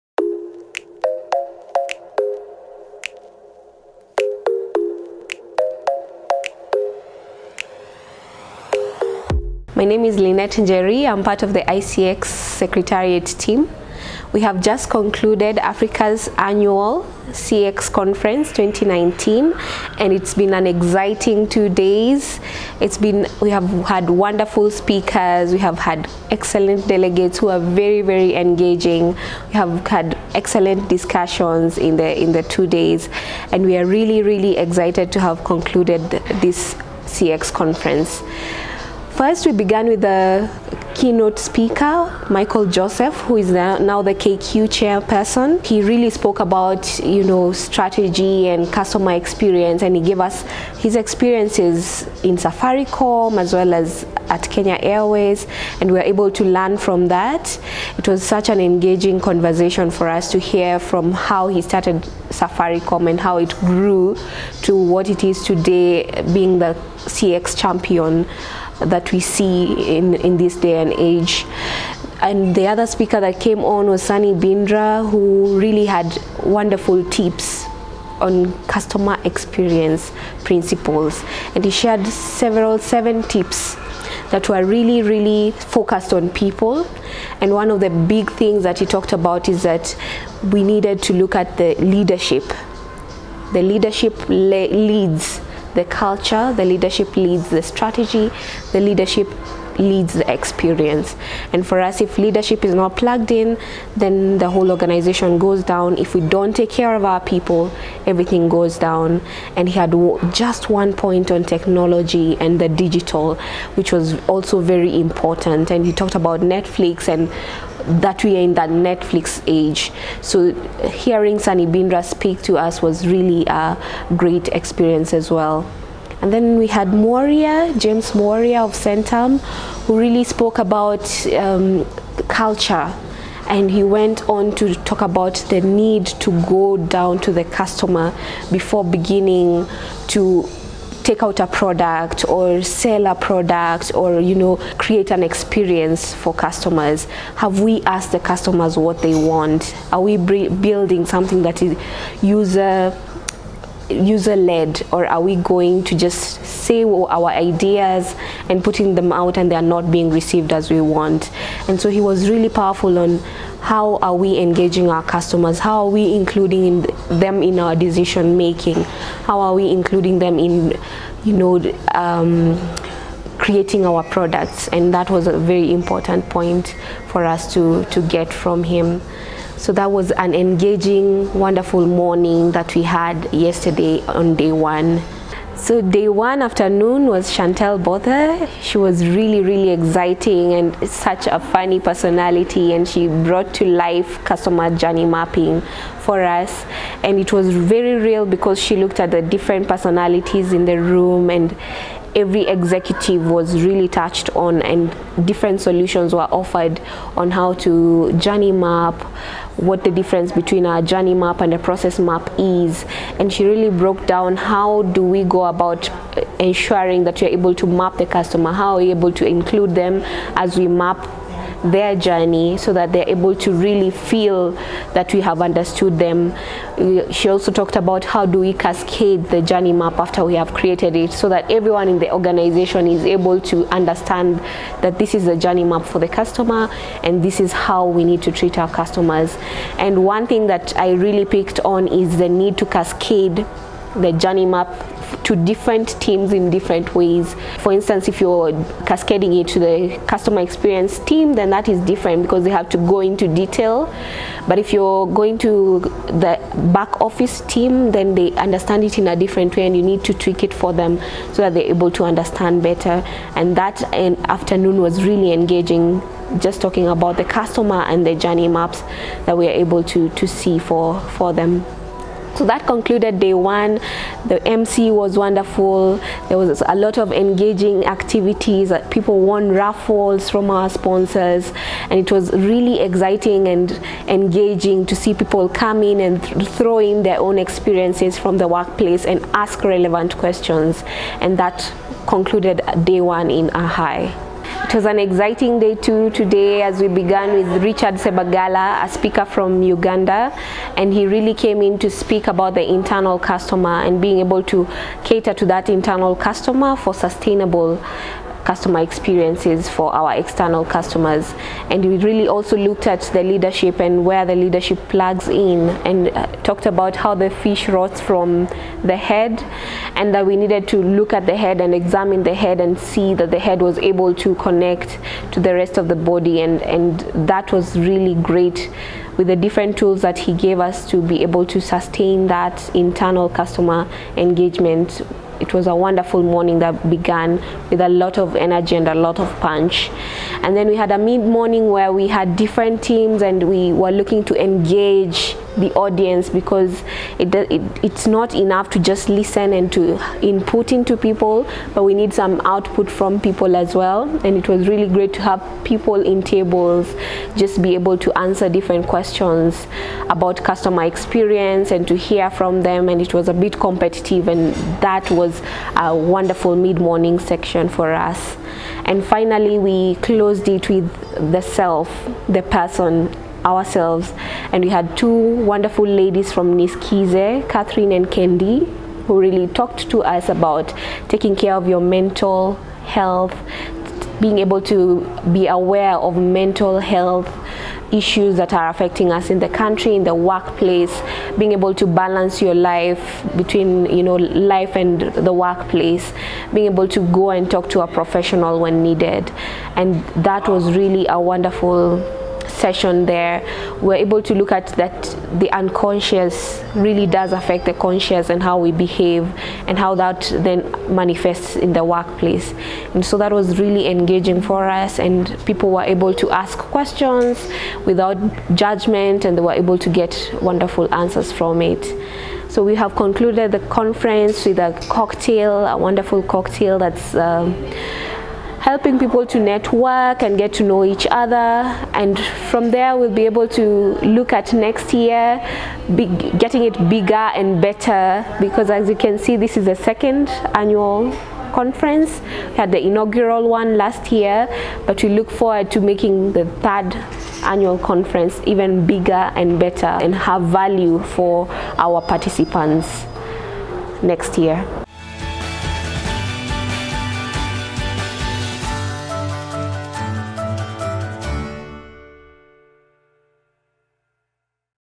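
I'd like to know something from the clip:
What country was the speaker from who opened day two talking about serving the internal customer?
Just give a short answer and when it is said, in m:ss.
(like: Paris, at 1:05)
Uganda, at 4:59.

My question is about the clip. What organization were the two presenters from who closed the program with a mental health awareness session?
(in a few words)
Niskize.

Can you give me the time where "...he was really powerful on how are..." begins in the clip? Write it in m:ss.
2:41.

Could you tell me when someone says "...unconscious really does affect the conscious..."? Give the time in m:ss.
6:45.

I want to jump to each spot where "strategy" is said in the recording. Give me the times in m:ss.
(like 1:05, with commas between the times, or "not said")
0:47, 1:37.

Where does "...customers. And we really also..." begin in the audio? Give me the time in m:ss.
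5:10.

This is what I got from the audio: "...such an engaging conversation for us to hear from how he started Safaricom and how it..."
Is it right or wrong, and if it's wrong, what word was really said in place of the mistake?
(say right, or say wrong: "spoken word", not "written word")
right.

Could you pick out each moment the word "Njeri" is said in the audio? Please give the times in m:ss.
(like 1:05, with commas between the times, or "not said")
0:10.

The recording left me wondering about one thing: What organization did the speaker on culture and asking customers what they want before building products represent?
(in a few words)
Centum.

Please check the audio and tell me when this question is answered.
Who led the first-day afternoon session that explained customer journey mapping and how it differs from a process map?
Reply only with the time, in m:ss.
3:07.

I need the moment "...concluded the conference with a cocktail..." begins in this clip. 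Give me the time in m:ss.
7:02.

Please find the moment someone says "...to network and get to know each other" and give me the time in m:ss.
7:09.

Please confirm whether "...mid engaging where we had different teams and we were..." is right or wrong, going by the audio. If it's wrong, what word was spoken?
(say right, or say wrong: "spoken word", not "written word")
wrong: "morning", not "engaging".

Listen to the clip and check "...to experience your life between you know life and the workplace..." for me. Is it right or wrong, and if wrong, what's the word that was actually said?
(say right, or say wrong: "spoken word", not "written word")
wrong: "balance", not "experience".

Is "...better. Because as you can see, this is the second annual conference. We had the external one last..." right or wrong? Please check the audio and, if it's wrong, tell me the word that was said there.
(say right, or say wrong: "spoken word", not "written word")
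wrong: "inaugural", not "external".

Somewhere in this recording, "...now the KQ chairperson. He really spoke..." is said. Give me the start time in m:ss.
0:43.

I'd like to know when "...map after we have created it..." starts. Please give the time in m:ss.
3:49.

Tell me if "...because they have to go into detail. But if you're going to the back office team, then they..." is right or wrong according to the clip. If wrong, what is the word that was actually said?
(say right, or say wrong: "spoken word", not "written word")
right.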